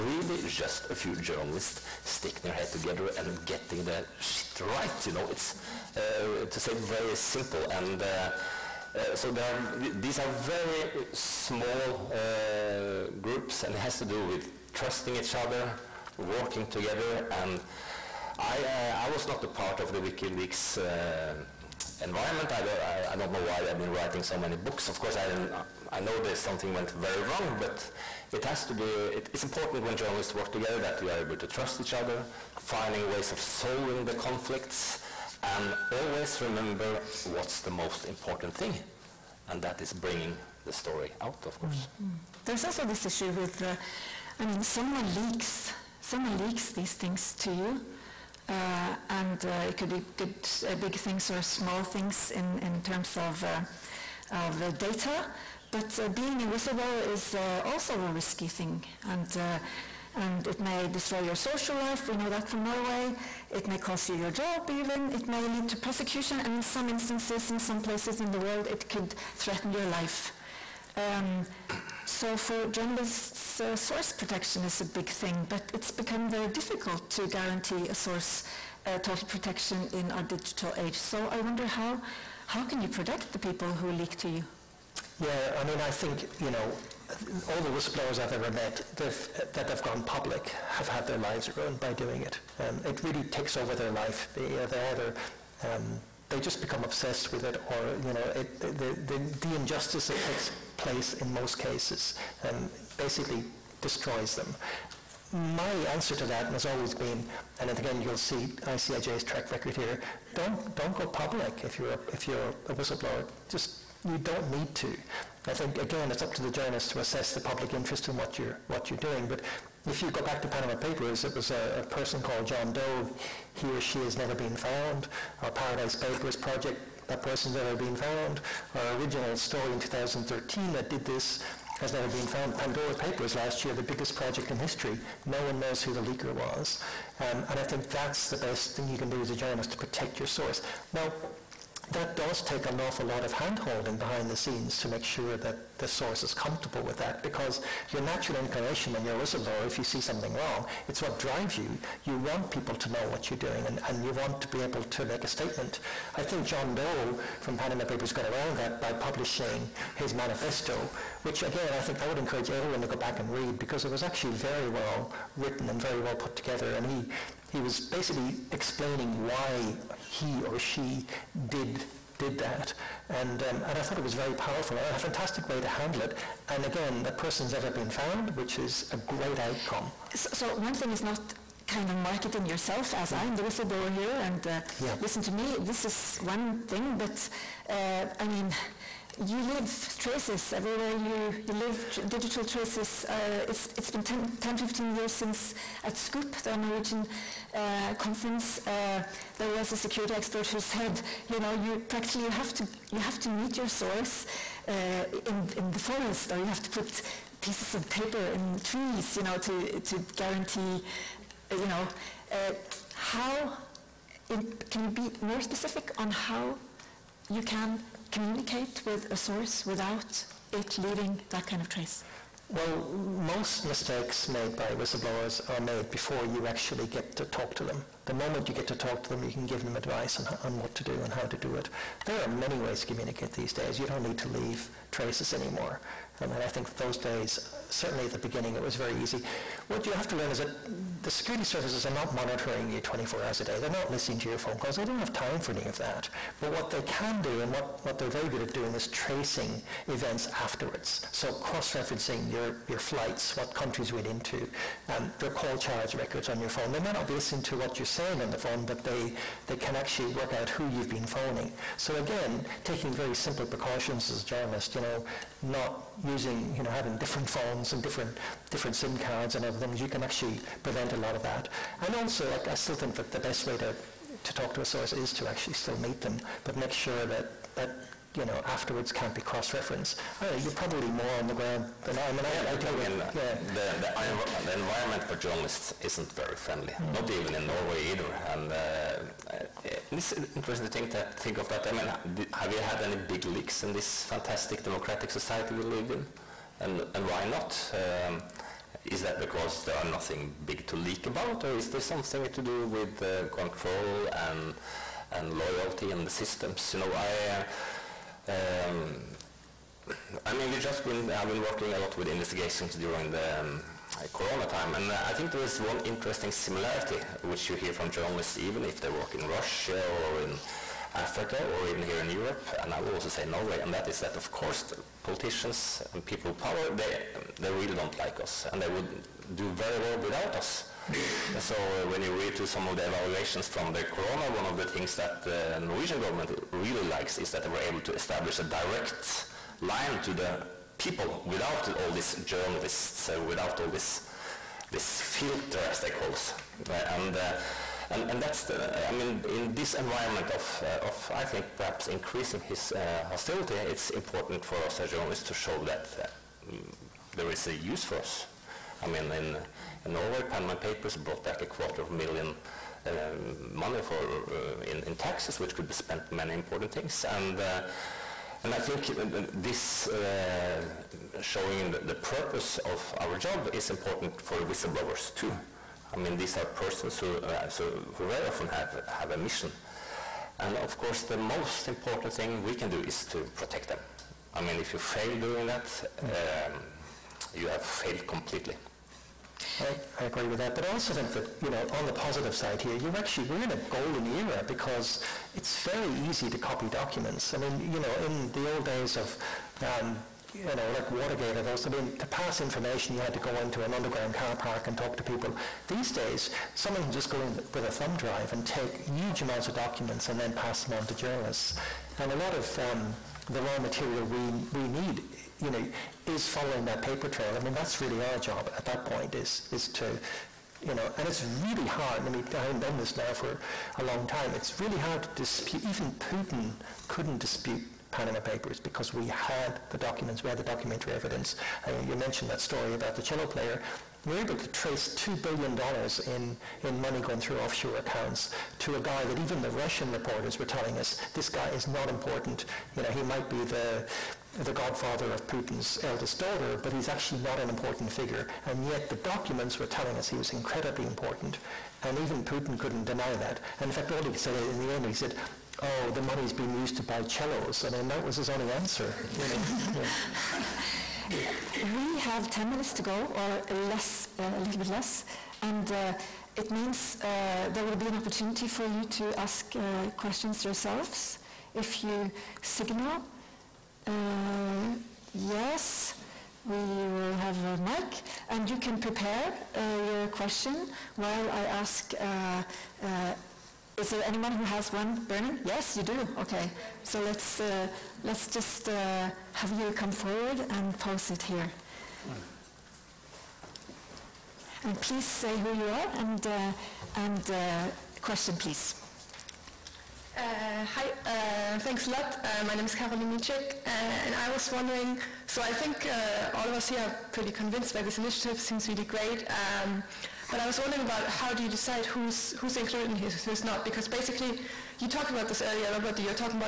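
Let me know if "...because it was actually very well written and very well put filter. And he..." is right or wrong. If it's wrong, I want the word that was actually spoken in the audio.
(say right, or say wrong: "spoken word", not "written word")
wrong: "together", not "filter".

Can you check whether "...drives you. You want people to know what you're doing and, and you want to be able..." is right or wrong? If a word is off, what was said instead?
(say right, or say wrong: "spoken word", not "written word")
right.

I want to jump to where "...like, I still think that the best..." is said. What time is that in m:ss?
4:32.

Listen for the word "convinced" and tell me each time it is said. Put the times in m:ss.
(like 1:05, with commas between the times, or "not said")
8:27.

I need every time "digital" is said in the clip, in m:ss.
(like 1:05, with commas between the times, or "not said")
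1:20, 3:12.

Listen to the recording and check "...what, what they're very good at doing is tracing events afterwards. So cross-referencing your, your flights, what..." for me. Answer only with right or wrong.
right.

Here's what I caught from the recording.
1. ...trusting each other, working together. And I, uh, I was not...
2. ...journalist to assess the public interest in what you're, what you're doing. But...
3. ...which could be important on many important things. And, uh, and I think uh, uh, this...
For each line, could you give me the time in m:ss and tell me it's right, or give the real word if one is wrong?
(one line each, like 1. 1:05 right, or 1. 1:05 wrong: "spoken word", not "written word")
1. 0:14 right
2. 1:56 right
3. 6:05 wrong: "spent", not "important".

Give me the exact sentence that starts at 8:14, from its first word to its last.
And please say who you are and and question, please.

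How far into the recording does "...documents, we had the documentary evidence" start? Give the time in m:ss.
7:09.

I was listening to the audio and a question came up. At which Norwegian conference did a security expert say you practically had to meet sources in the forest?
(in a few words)
Scoop.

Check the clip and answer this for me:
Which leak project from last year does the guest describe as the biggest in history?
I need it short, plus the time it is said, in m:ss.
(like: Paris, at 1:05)
Pandora Papers, at 2:12.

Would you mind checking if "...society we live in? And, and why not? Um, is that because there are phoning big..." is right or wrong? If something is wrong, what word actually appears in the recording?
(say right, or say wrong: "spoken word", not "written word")
wrong: "nothing", not "phoning".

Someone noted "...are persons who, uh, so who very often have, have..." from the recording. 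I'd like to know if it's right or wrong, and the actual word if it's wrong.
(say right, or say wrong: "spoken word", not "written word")
right.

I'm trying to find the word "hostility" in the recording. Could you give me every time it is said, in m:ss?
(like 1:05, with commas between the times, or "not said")
5:53.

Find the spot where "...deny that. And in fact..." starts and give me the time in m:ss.
7:32.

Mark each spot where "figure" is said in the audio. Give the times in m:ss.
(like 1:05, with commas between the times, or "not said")
7:27.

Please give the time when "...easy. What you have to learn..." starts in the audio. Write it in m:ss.
3:58.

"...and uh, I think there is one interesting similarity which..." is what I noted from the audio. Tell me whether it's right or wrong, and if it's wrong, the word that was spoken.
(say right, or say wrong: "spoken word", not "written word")
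right.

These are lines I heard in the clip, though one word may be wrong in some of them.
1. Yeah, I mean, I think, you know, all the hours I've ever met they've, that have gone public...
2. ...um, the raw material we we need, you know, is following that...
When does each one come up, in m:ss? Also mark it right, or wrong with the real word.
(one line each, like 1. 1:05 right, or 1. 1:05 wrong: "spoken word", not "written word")
1. 1:25 wrong: "whistleblowers", not "hours"
2. 6:52 right.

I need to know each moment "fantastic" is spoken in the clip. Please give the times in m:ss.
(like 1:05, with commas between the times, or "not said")
2:54, 4:54.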